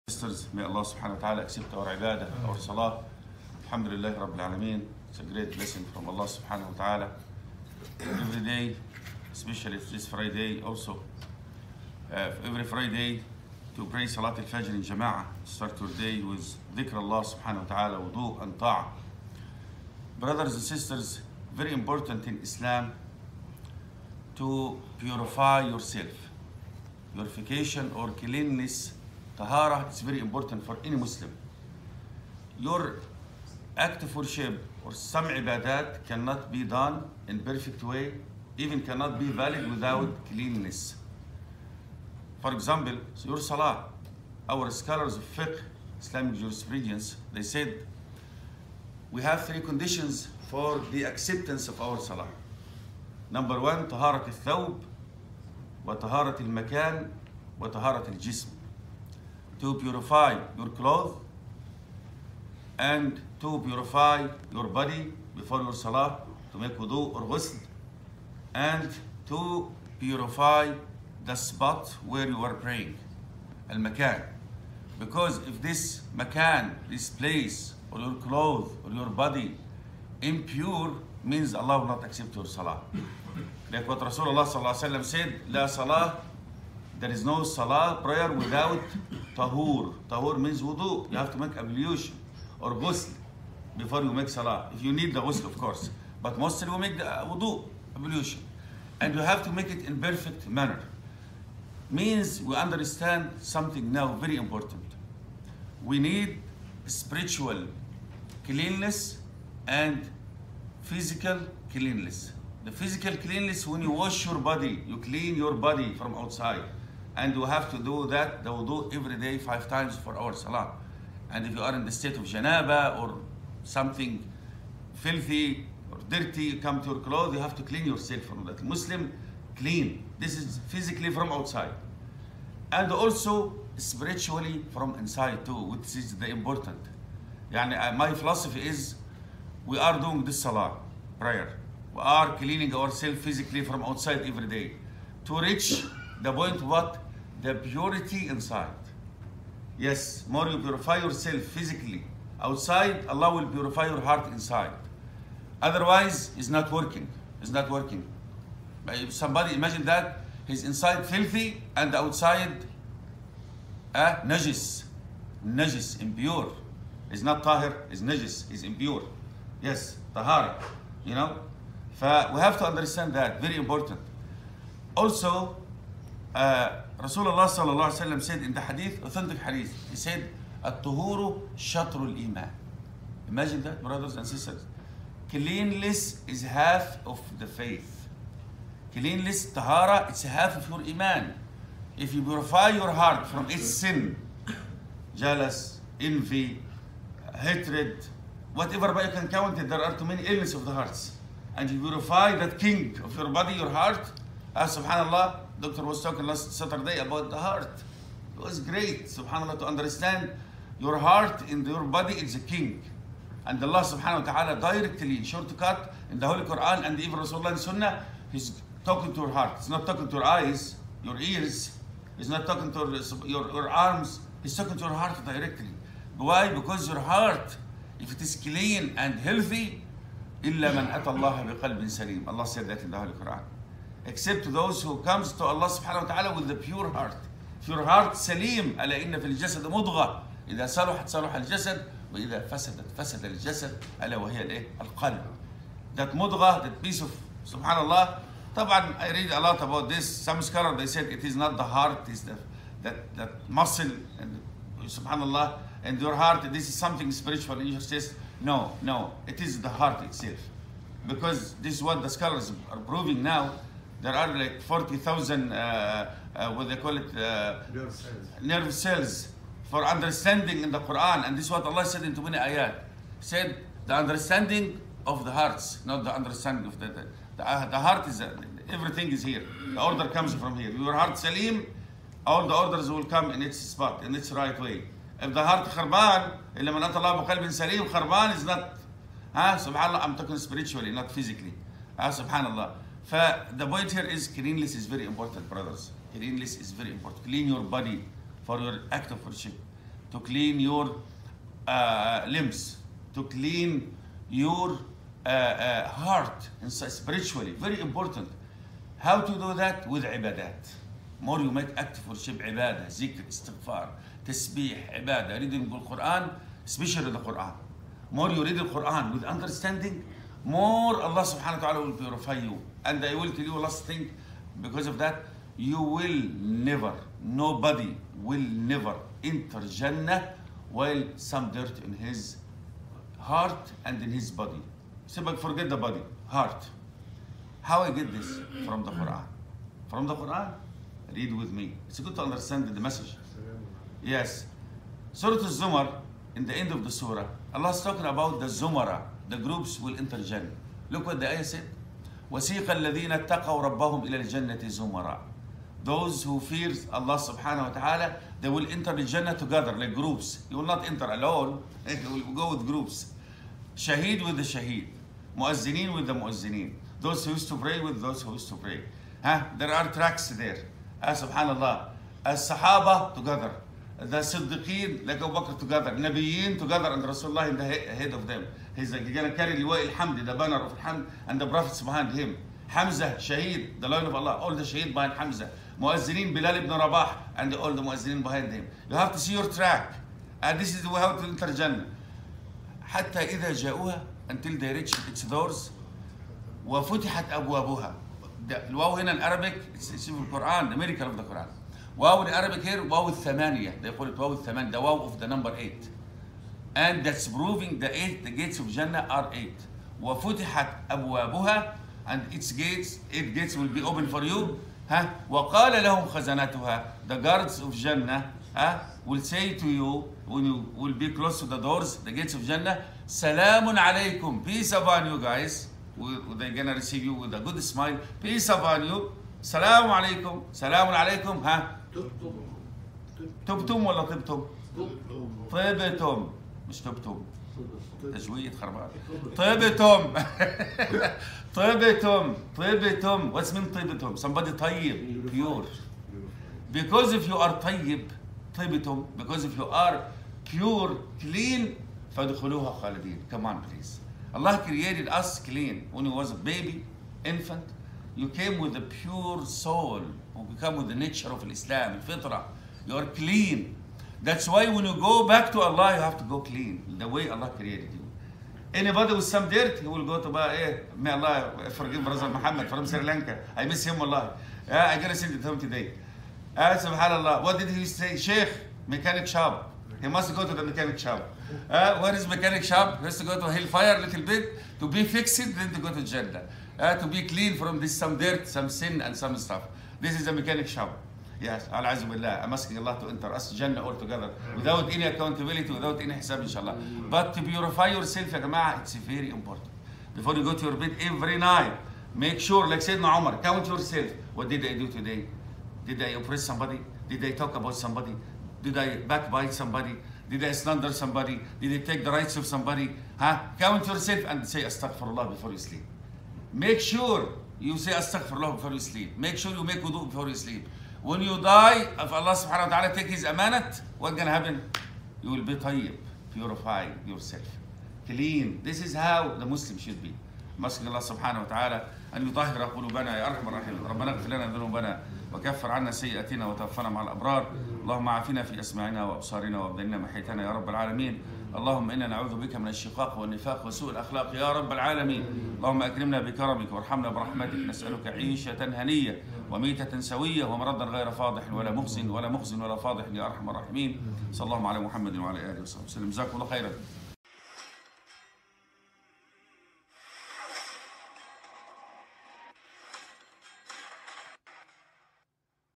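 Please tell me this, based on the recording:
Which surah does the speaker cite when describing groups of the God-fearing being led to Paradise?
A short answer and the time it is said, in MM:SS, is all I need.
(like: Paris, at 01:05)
Surah Al-Zumar, at 05:45.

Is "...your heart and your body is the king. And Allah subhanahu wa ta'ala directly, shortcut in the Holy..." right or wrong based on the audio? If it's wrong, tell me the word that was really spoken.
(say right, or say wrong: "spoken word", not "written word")
right.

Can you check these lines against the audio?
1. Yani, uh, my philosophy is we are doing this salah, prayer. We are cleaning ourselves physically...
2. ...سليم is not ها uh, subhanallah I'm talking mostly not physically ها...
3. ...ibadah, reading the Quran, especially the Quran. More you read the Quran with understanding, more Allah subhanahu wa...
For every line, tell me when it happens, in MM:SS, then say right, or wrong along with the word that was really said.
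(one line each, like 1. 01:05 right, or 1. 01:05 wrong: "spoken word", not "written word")
1. 02:17 right
2. 04:47 wrong: "spiritually", not "mostly"
3. 05:15 right.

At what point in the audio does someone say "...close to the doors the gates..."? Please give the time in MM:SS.
07:01.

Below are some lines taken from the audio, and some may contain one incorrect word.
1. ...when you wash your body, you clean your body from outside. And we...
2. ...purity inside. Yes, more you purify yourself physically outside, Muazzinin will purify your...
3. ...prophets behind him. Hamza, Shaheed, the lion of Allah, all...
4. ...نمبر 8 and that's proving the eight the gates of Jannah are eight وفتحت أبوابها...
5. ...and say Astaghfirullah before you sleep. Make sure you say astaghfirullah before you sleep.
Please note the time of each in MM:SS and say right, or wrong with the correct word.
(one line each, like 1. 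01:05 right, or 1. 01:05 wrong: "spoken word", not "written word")
1. 01:53 right
2. 02:27 wrong: "Allah", not "Muazzinin"
3. 06:21 right
4. 06:45 right
5. 08:34 right.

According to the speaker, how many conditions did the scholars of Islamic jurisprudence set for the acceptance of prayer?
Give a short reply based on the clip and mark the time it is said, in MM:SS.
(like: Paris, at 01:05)
3, at 00:49.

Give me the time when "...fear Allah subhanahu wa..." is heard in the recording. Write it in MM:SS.
05:56.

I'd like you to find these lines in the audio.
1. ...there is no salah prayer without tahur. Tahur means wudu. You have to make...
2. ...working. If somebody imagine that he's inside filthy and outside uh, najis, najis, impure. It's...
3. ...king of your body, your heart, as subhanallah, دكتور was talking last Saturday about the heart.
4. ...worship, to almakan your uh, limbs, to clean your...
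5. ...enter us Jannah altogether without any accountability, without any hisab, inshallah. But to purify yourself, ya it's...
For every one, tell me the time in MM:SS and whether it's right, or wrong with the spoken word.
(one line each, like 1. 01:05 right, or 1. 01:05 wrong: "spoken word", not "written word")
1. 01:26 right
2. 02:37 right
3. 03:22 right
4. 04:59 wrong: "clean", not "almakan"
5. 08:13 right.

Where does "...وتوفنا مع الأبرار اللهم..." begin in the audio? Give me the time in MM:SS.
08:56.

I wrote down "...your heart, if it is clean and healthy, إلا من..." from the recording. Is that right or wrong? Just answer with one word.
right.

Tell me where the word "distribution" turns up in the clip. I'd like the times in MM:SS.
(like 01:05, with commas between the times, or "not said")
not said.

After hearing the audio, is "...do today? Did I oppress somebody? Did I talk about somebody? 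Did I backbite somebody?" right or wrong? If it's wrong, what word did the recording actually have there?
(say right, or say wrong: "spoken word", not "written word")
right.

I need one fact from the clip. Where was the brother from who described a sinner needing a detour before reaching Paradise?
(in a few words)
Sri Lanka.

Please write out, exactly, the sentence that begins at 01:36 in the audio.
But mostly we make the wudu, ablution.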